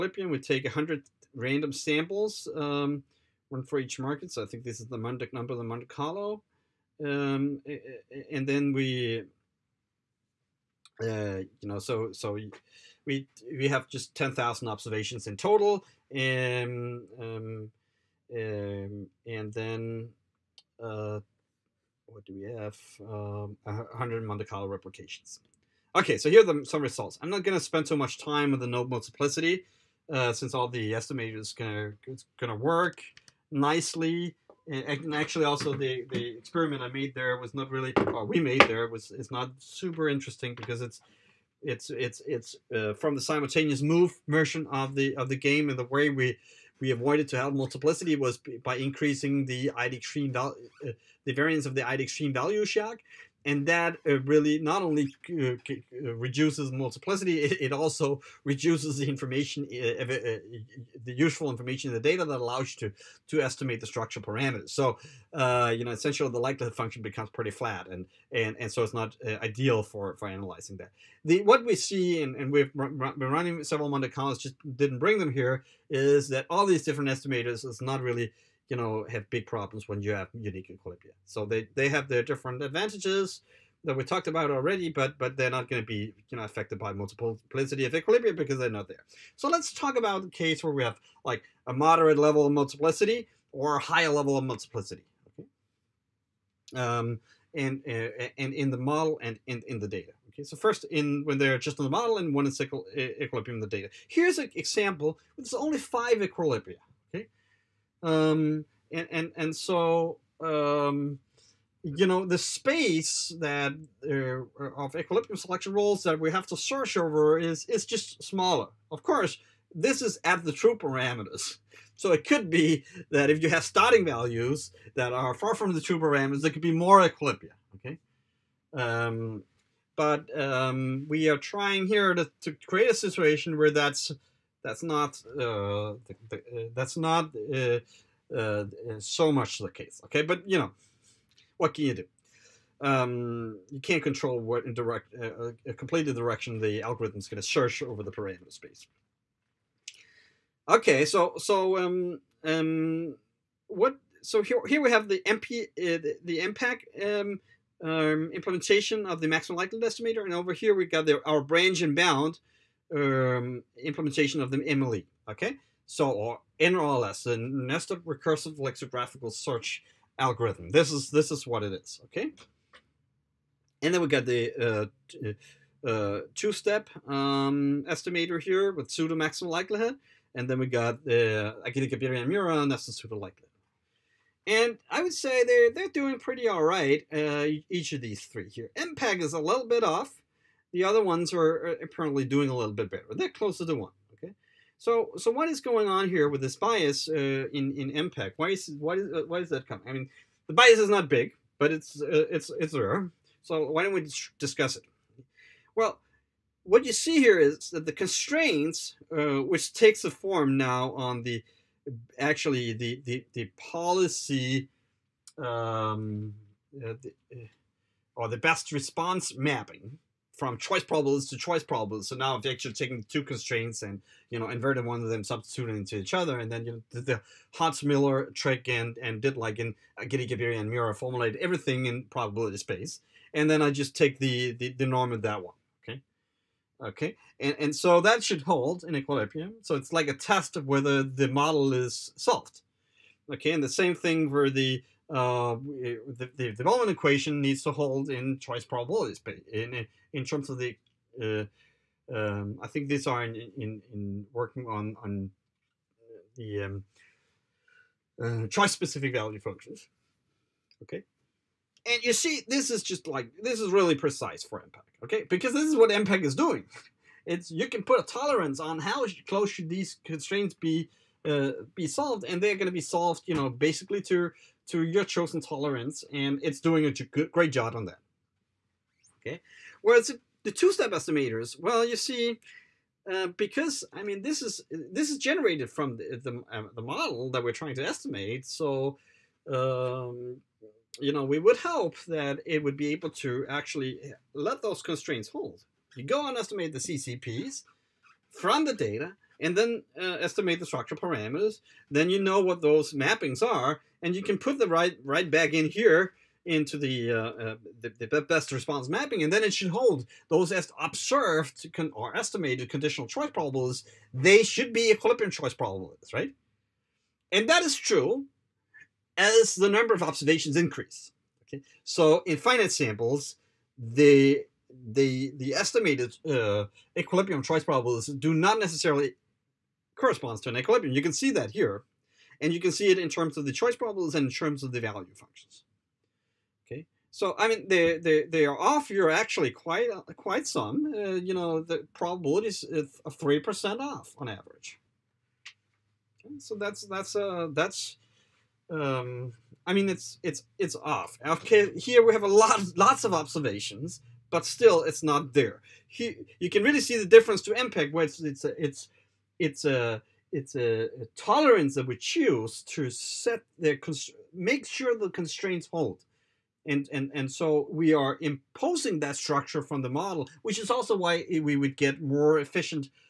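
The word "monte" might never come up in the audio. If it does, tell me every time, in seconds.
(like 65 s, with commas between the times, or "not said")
5 s, 24 s, 73 s.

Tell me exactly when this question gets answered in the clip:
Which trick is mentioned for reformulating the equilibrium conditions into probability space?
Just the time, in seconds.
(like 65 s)
227 s.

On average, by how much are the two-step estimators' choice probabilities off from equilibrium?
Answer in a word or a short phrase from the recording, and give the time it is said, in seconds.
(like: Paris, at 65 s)
3 percent, at 343 s.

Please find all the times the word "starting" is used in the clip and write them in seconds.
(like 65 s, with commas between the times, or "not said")
123 s.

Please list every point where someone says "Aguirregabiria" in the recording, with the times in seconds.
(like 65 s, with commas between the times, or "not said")
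181 s, 230 s.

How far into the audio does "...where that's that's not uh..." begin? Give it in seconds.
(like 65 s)
133 s.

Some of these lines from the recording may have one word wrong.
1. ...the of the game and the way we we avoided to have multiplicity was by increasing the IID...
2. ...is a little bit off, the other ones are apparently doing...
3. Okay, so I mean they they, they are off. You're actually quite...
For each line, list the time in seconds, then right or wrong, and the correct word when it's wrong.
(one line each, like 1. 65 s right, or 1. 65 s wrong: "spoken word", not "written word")
1. 44 s right
2. 189 s right
3. 336 s right.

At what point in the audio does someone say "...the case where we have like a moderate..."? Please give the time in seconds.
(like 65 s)
90 s.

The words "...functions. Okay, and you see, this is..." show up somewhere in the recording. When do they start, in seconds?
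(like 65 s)
259 s.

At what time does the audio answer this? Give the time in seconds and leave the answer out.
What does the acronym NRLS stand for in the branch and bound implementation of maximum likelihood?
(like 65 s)
167 s.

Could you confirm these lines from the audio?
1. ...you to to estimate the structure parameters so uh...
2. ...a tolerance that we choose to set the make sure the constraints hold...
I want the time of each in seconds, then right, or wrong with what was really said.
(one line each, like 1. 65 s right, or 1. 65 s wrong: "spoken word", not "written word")
1. 62 s right
2. 361 s right.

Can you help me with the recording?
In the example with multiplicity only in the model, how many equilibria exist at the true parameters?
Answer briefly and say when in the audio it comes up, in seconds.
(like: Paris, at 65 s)
5, at 105 s.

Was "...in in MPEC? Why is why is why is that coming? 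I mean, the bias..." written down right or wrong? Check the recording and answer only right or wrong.
right.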